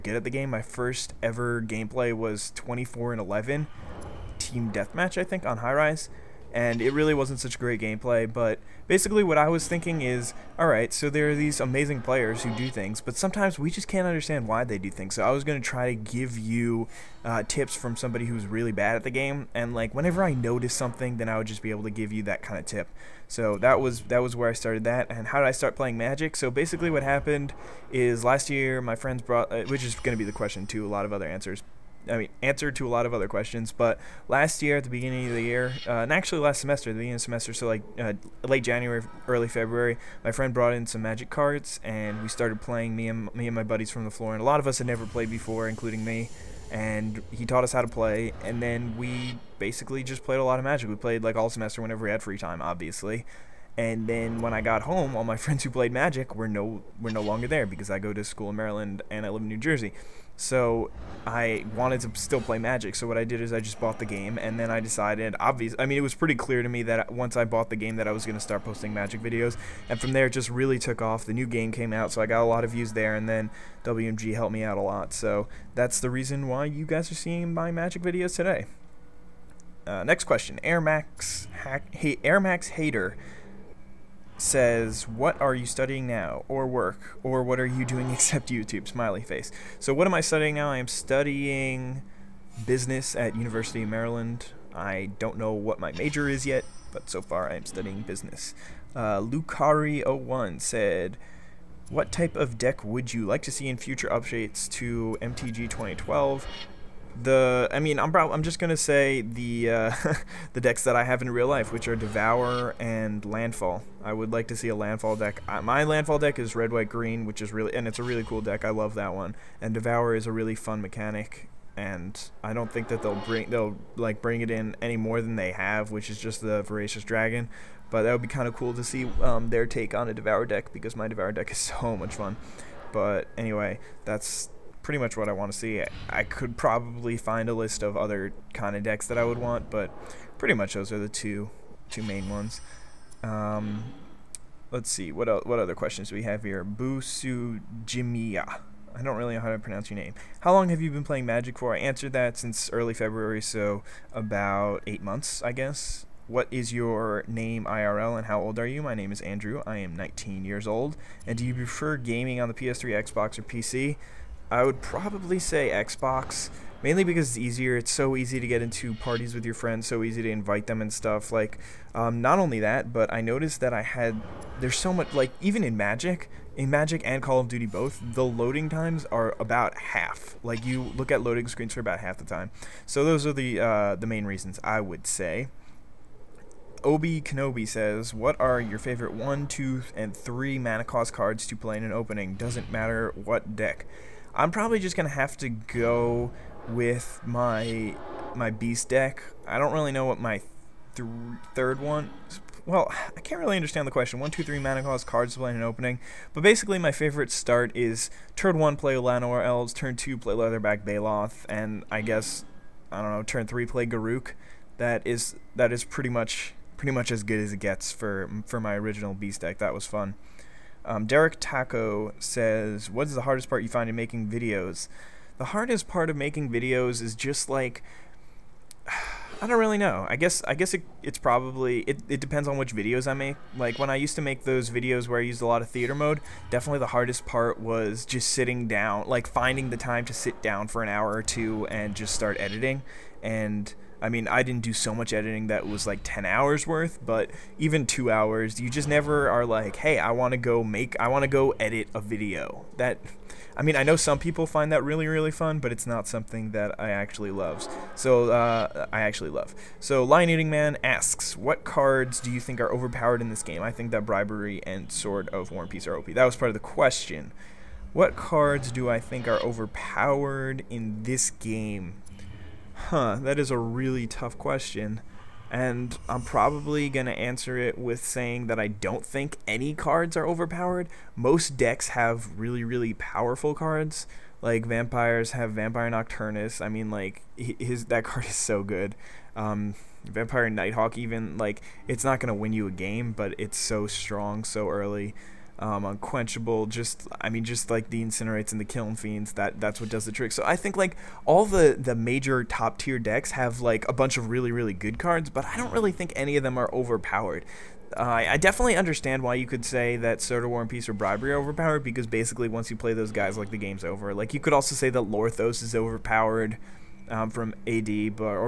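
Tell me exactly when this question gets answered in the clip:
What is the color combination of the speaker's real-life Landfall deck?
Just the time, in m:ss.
1:56.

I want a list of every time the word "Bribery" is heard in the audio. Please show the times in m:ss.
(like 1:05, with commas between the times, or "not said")
4:24, 5:10.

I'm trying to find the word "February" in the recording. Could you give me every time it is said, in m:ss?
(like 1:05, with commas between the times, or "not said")
0:39, 2:32.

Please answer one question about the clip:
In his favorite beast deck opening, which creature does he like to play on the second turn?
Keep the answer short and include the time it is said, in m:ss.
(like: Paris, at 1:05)
Leatherback Baloth, at 3:30.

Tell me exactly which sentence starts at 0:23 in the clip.
So that was that was where I started that.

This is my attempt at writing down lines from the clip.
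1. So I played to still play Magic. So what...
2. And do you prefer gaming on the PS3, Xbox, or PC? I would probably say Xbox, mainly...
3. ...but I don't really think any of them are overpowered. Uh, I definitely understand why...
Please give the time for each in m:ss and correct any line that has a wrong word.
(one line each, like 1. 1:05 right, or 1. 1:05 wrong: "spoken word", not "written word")
1. 1:00 wrong: "wanted", not "played"
2. 2:41 right
3. 5:05 right.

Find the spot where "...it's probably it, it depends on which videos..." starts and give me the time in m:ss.
3:51.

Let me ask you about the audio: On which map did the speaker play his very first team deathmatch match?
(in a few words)
High Rise.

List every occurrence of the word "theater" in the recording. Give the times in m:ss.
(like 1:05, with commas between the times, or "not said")
3:55.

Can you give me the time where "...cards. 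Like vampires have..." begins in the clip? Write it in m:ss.
4:43.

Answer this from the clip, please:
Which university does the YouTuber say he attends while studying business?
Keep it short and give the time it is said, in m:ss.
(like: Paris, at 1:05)
University of Maryland, at 1:33.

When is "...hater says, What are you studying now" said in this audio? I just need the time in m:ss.
1:22.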